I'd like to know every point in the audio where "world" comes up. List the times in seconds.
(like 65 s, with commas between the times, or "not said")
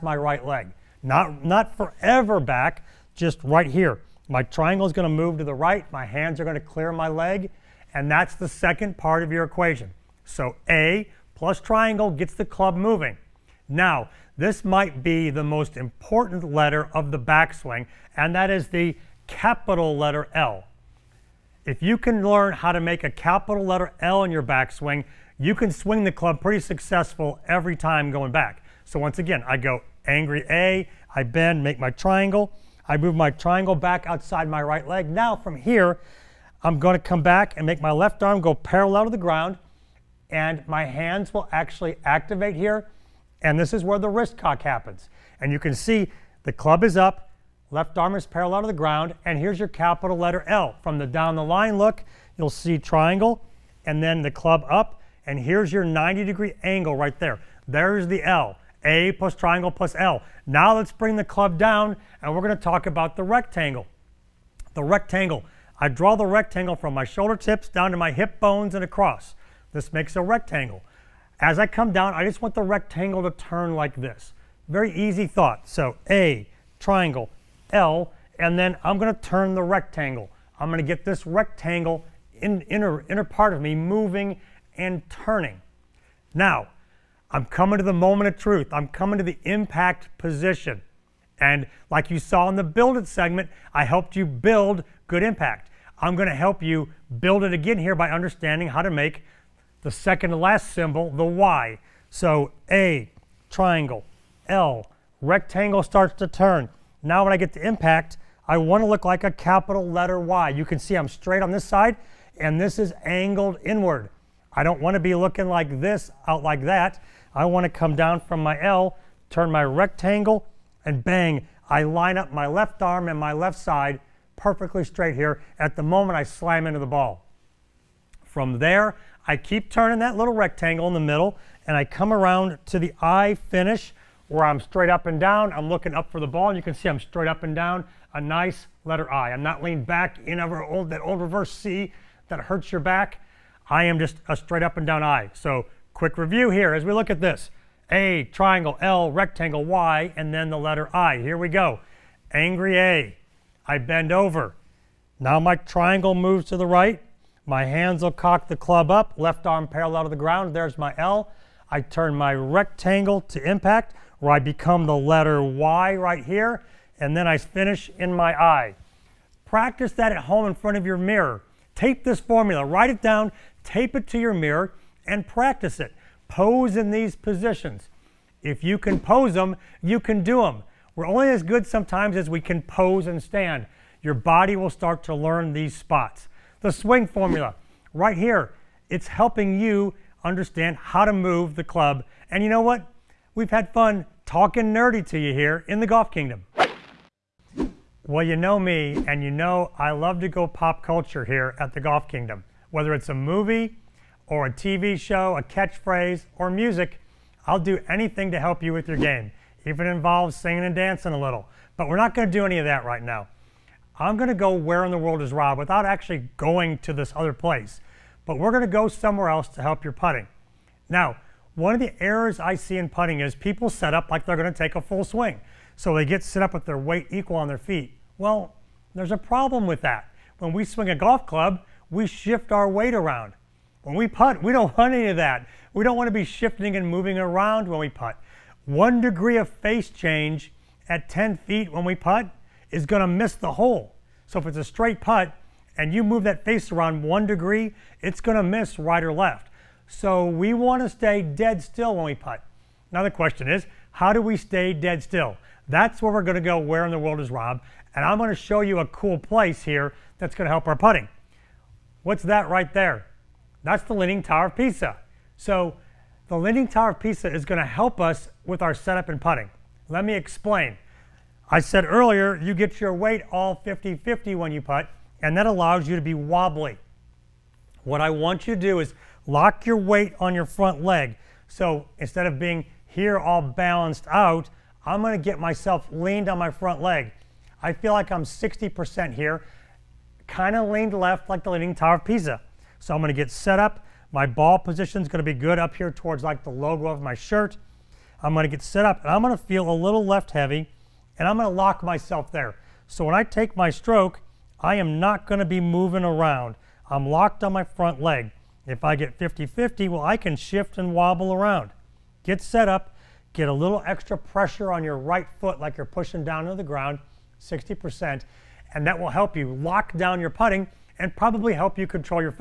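214 s, 256 s.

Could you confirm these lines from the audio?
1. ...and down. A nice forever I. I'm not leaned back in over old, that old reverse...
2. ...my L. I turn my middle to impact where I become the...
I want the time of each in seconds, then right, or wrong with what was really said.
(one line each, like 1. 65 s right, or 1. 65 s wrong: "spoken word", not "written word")
1. 137 s wrong: "letter", not "forever"
2. 160 s wrong: "rectangle", not "middle".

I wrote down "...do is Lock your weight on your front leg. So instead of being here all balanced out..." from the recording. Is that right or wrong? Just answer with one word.
right.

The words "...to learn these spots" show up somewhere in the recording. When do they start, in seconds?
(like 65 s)
185 s.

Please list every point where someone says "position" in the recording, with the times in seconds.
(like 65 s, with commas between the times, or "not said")
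90 s, 177 s, 294 s.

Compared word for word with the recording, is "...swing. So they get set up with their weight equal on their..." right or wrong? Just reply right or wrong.
right.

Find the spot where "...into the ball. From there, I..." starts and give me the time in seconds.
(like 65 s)
126 s.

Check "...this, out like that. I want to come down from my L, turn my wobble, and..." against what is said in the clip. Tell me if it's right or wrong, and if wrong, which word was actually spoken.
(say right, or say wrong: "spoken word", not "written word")
wrong: "rectangle", not "wobble".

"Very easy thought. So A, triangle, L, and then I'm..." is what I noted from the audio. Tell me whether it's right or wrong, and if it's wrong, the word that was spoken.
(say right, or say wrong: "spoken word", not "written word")
right.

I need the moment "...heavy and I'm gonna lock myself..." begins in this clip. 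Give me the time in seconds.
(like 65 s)
300 s.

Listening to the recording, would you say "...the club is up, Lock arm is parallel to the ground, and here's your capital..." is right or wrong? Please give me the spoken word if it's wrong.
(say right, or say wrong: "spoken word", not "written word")
wrong: "Left", not "Lock".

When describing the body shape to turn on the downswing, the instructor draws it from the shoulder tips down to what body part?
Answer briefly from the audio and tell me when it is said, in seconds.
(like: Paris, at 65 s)
Hip bones, at 68 s.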